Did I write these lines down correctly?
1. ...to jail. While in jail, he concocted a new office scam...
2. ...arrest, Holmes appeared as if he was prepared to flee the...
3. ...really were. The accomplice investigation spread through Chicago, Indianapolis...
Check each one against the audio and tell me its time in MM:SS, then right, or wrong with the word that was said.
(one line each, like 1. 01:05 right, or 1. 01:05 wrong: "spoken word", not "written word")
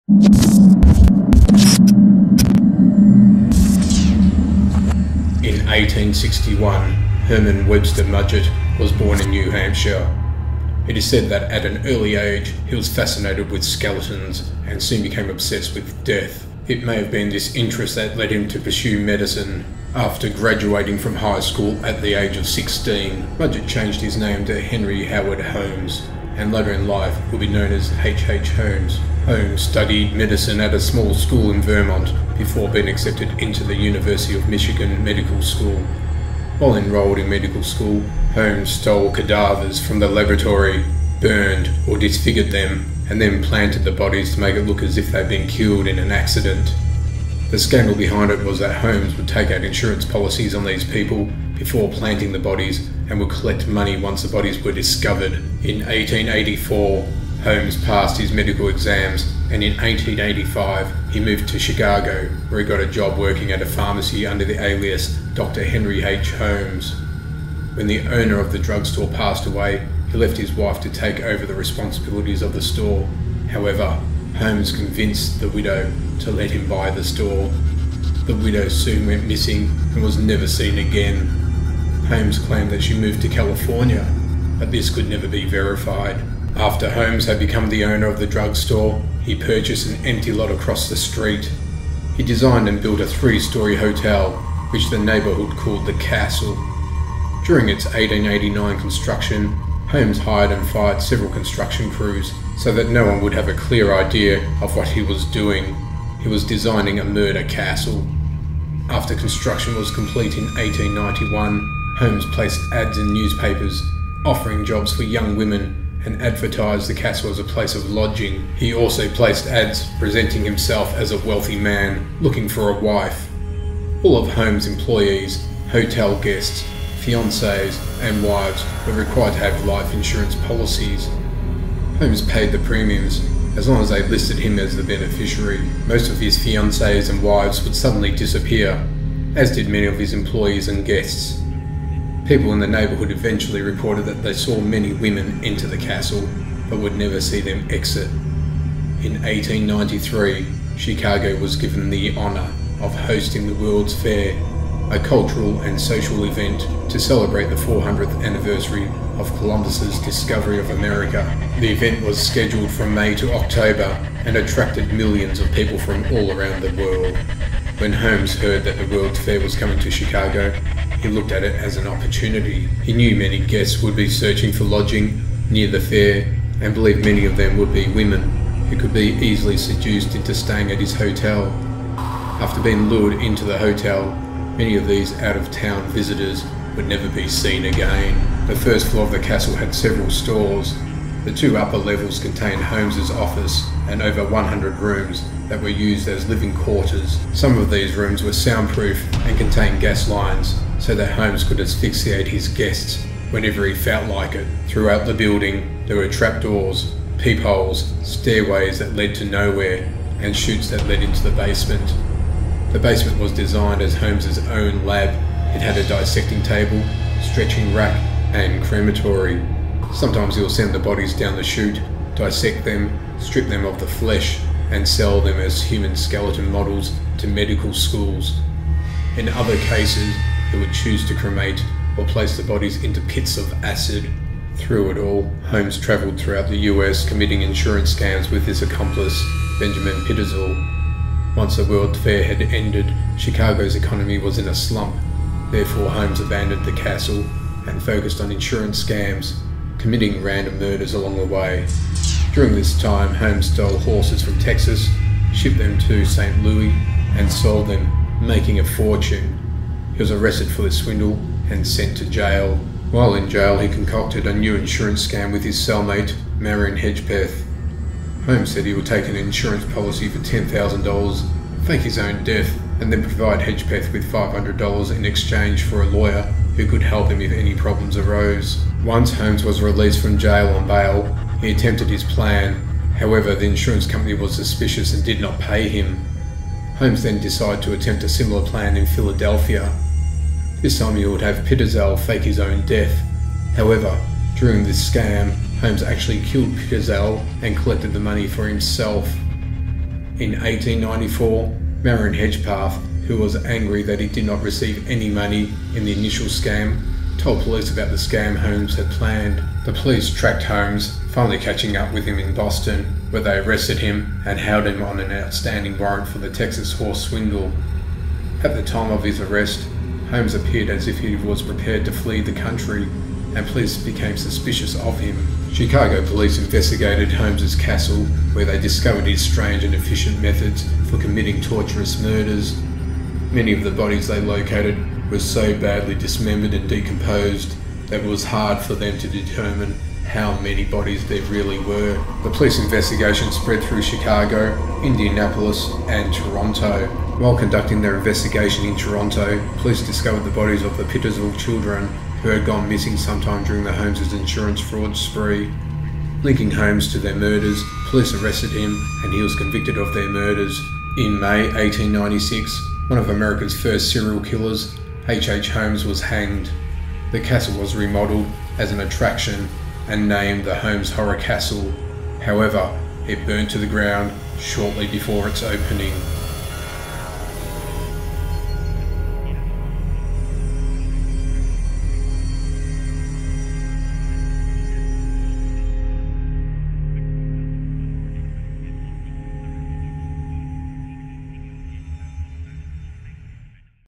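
1. 04:21 wrong: "insurance", not "office"
2. 05:19 right
3. 05:41 wrong: "police", not "accomplice".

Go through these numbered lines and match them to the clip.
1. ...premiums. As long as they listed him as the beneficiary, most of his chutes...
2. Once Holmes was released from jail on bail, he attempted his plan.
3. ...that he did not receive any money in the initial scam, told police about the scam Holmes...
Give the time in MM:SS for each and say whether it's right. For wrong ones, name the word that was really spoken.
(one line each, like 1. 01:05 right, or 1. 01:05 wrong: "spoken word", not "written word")
1. 02:12 wrong: "fiancées", not "chutes"
2. 04:38 right
3. 05:03 right.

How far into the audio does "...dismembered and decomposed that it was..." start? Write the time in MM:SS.
05:35.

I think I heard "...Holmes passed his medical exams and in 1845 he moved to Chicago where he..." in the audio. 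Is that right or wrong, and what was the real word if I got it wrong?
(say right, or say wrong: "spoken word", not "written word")
wrong: "1885", not "1845".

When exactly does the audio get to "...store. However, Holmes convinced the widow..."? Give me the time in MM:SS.
01:12.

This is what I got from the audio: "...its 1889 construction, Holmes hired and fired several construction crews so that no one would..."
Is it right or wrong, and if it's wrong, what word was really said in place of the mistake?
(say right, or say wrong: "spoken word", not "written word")
right.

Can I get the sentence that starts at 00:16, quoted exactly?
It may have been this interest that led him to pursue medicine.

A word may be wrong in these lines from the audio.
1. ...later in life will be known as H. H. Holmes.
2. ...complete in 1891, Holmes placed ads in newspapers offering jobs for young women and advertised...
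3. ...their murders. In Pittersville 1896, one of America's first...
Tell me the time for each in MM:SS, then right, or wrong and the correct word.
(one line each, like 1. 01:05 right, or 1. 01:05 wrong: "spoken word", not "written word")
1. 00:26 right
2. 01:49 right
3. 05:59 wrong: "May", not "Pittersville".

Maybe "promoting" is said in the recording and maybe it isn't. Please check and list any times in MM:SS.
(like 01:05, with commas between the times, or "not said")
not said.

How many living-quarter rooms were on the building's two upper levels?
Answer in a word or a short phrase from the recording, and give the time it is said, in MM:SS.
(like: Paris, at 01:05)
over 100, at 03:14.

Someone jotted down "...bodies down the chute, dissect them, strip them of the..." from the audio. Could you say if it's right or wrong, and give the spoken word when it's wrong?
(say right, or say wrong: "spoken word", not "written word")
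right.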